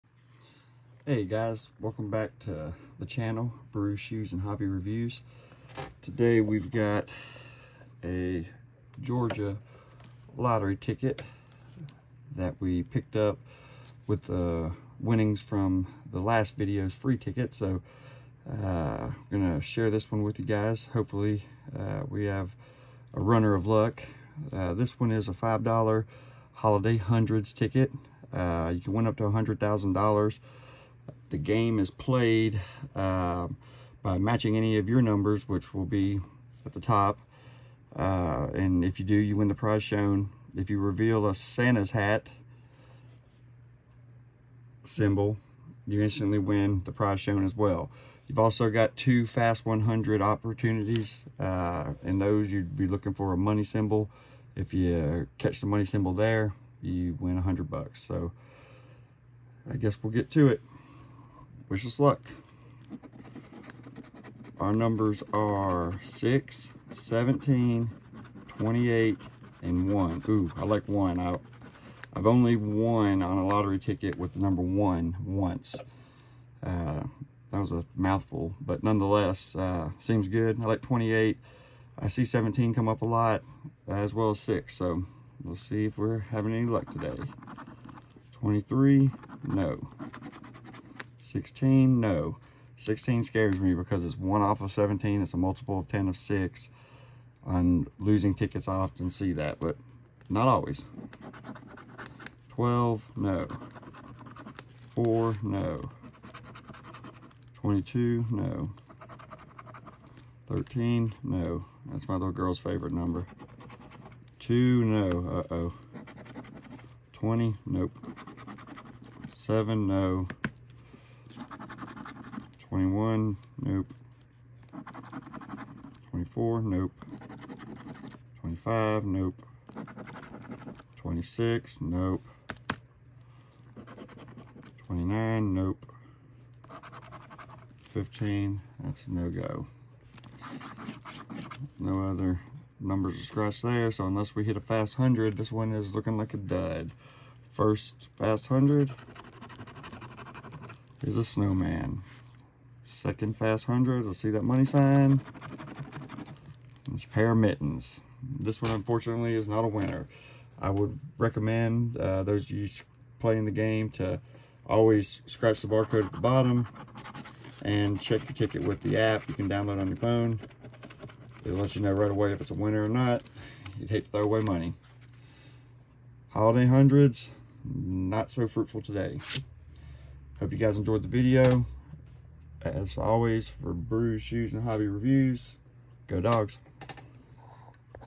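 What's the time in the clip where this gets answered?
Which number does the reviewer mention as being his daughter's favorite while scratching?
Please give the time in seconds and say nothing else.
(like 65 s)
110 s.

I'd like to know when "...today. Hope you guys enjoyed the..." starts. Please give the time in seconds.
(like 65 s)
178 s.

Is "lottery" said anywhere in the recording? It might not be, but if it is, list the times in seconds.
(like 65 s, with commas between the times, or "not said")
10 s, 73 s.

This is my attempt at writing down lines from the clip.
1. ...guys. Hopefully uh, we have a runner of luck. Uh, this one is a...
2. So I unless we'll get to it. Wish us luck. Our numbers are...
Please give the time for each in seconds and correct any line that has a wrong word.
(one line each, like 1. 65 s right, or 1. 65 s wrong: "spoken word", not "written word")
1. 20 s right
2. 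58 s wrong: "guess", not "unless".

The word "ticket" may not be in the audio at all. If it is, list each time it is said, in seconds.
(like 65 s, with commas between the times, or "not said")
10 s, 17 s, 27 s, 73 s, 98 s, 168 s.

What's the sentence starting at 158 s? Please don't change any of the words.
This one, unfortunately, is not a winner.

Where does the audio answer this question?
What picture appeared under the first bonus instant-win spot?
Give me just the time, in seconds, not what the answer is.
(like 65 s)
151 s.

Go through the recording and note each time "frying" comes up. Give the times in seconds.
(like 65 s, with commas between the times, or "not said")
not said.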